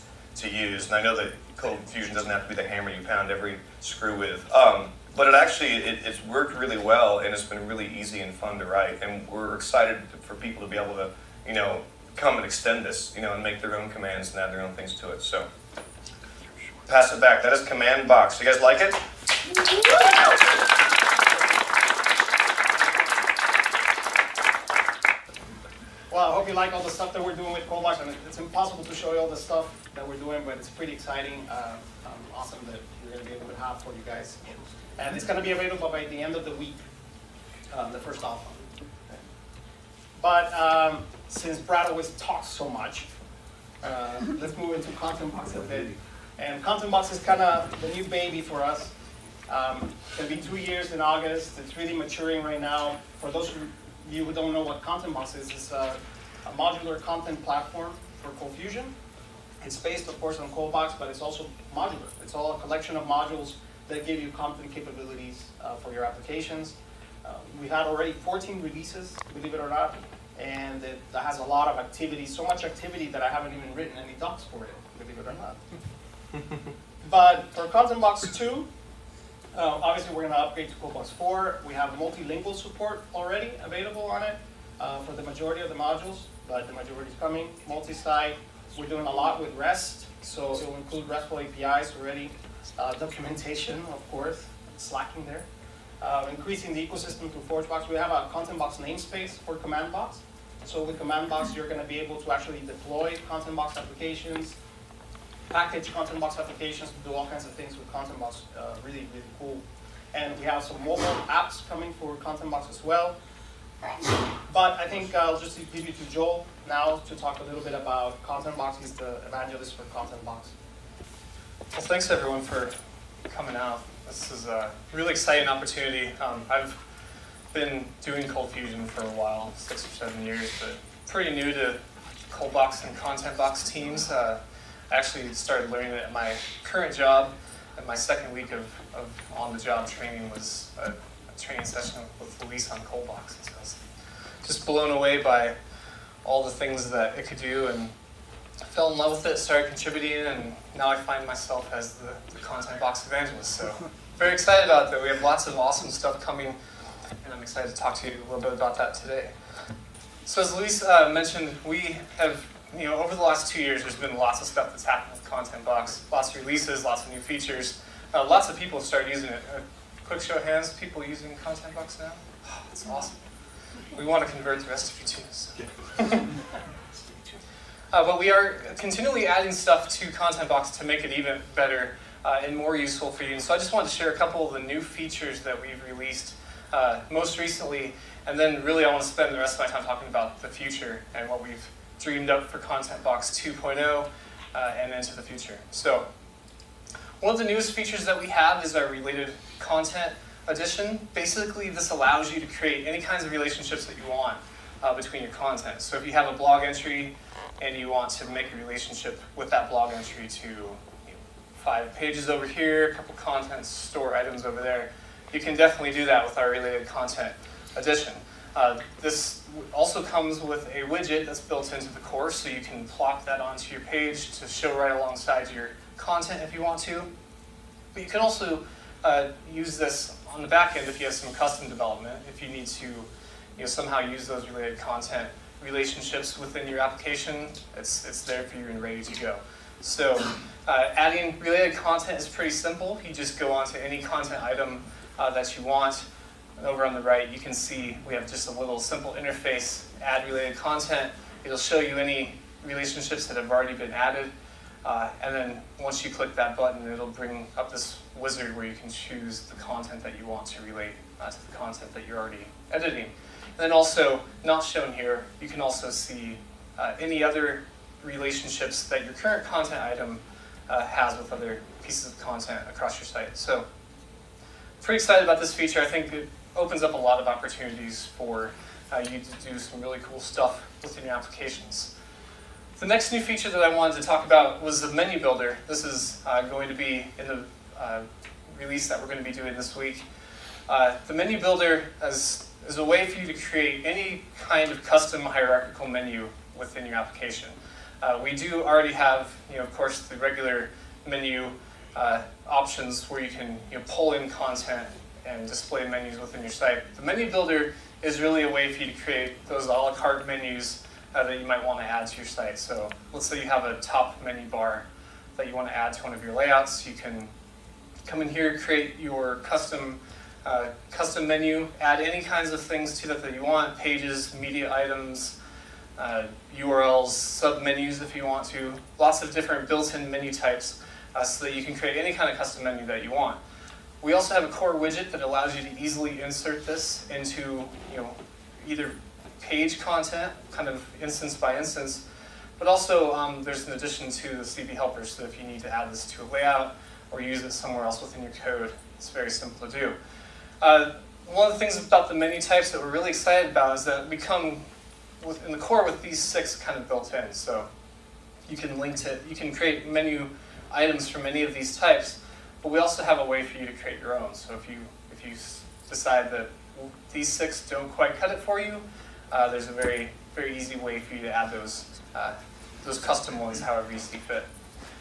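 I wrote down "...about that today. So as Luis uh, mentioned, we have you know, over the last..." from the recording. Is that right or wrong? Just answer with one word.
right.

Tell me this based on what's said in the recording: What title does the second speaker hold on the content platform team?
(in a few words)
ContentBox evangelist.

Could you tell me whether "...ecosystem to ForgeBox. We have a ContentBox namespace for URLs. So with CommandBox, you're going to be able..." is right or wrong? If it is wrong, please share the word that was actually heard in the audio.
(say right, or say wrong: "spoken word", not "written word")
wrong: "CommandBox", not "URLs".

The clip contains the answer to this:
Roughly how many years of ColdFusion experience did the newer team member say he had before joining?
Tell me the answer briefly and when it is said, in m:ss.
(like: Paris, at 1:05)
six or seven, at 2:09.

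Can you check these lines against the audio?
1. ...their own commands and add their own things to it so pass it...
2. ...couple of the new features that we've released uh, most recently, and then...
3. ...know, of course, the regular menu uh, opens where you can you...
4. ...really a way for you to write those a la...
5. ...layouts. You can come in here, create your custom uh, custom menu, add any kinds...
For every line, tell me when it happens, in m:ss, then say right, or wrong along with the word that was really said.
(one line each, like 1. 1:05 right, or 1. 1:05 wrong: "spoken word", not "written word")
1. 0:13 right
2. 3:04 right
3. 4:59 wrong: "options", not "opens"
4. 5:08 wrong: "create", not "write"
5. 5:16 right.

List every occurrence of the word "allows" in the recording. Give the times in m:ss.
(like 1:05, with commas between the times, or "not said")
3:21, 5:35.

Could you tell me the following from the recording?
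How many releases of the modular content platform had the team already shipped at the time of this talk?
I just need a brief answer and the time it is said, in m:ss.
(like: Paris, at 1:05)
14, at 1:08.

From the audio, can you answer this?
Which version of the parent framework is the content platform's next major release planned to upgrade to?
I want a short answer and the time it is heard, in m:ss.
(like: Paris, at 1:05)
ColdBox 4, at 1:20.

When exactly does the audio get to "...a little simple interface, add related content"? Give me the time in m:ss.
4:08.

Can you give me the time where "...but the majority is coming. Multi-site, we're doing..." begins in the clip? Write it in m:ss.
1:26.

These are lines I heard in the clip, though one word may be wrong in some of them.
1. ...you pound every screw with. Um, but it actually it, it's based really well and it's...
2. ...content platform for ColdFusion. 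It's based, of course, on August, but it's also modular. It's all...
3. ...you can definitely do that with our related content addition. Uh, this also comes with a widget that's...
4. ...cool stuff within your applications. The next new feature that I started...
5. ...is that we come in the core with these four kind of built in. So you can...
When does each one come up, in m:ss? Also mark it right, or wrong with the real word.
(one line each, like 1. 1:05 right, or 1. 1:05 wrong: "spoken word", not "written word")
1. 0:02 wrong: "worked", not "based"
2. 0:56 wrong: "ColdBox", not "August"
3. 3:35 right
4. 4:40 wrong: "wanted", not "started"
5. 5:53 wrong: "six", not "four".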